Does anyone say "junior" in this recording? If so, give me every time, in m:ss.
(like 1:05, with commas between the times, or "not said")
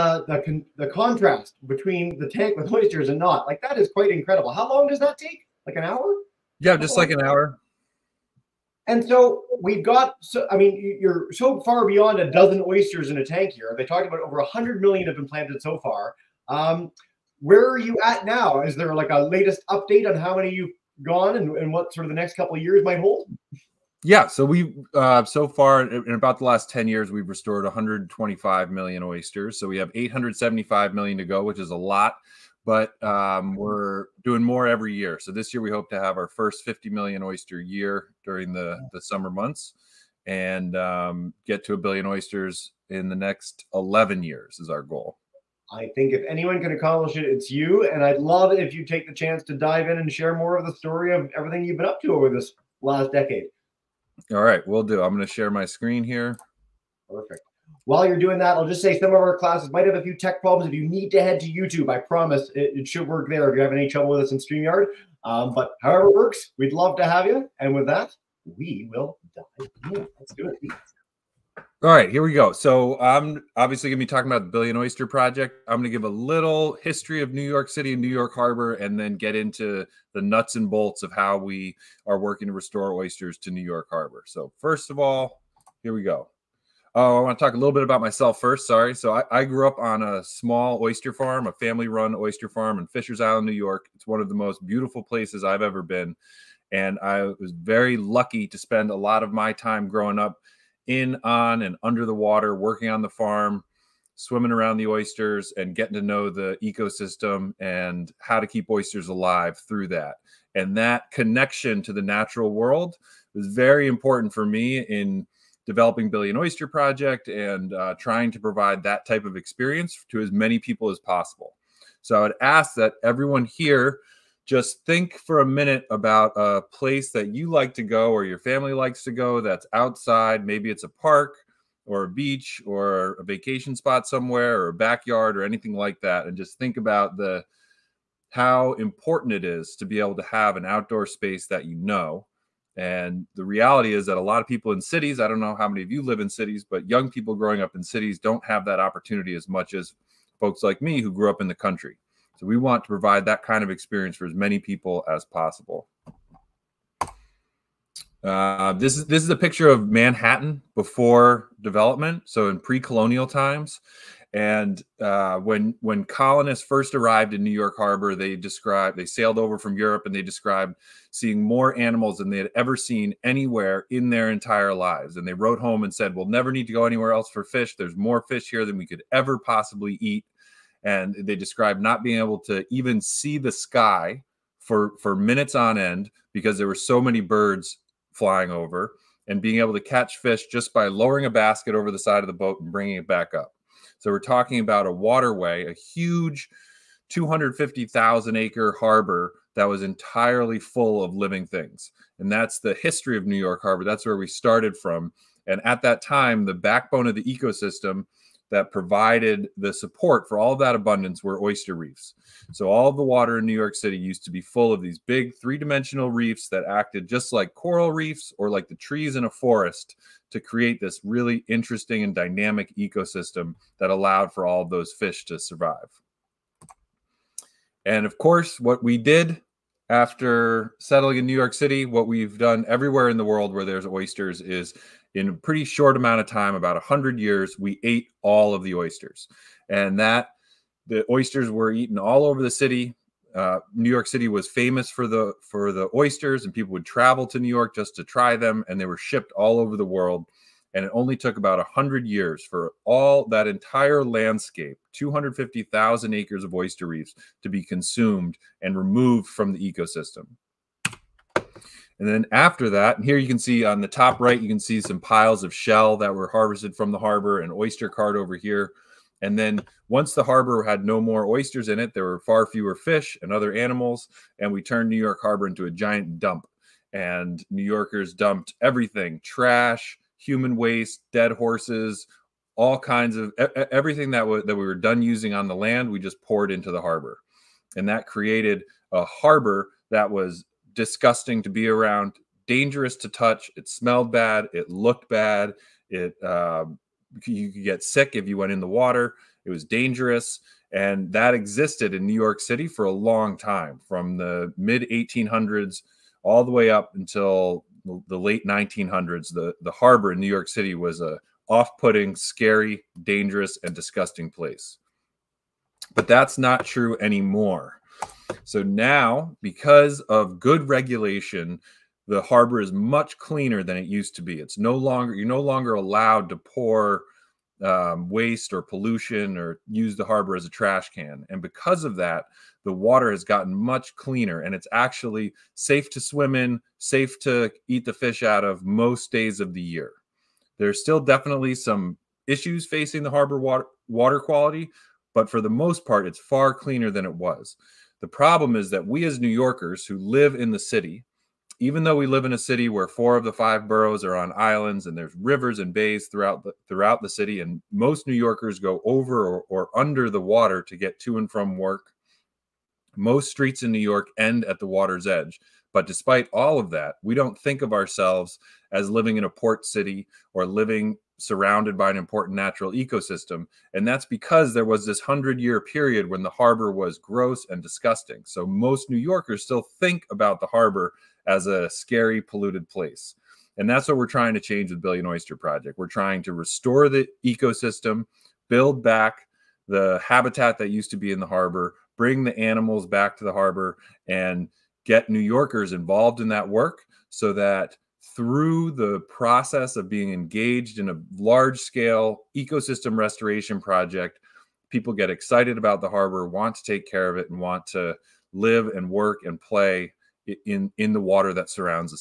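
not said.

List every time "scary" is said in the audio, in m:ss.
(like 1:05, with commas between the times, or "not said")
5:12, 6:21.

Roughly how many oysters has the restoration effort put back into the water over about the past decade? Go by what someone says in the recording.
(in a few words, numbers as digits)
125 million.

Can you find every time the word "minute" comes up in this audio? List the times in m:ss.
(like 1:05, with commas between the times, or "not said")
2:05, 3:05.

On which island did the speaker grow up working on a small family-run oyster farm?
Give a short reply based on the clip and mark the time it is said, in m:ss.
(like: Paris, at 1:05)
Fishers Island, at 1:32.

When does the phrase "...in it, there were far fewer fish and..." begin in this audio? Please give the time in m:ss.
4:31.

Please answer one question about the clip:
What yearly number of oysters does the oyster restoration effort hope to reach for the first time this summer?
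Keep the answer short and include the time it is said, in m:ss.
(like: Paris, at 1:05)
50 million, at 0:36.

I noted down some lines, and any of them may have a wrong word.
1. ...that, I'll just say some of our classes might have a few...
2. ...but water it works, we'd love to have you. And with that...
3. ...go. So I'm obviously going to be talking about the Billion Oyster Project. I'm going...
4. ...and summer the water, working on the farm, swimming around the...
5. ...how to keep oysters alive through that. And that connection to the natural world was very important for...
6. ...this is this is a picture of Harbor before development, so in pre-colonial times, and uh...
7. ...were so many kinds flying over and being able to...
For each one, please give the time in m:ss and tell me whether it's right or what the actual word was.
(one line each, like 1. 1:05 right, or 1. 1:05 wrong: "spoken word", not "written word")
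1. 0:58 right
2. 1:05 wrong: "however", not "water"
3. 1:12 right
4. 1:41 wrong: "under", not "summer"
5. 1:48 right
6. 2:38 wrong: "Manhattan", not "Harbor"
7. 3:06 wrong: "birds", not "kinds".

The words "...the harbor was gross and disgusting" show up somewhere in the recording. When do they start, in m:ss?
6:16.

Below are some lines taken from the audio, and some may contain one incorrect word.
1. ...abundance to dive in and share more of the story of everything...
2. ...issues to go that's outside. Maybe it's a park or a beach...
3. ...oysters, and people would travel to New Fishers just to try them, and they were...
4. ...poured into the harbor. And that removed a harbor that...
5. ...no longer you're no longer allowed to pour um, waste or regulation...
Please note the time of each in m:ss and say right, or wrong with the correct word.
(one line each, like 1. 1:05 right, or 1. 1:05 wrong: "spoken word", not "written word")
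1. 0:49 wrong: "chance", not "abundance"
2. 2:08 wrong: "likes", not "issues"
3. 4:05 wrong: "York", not "Fishers"
4. 4:46 wrong: "created", not "removed"
5. 5:24 wrong: "pollution", not "regulation".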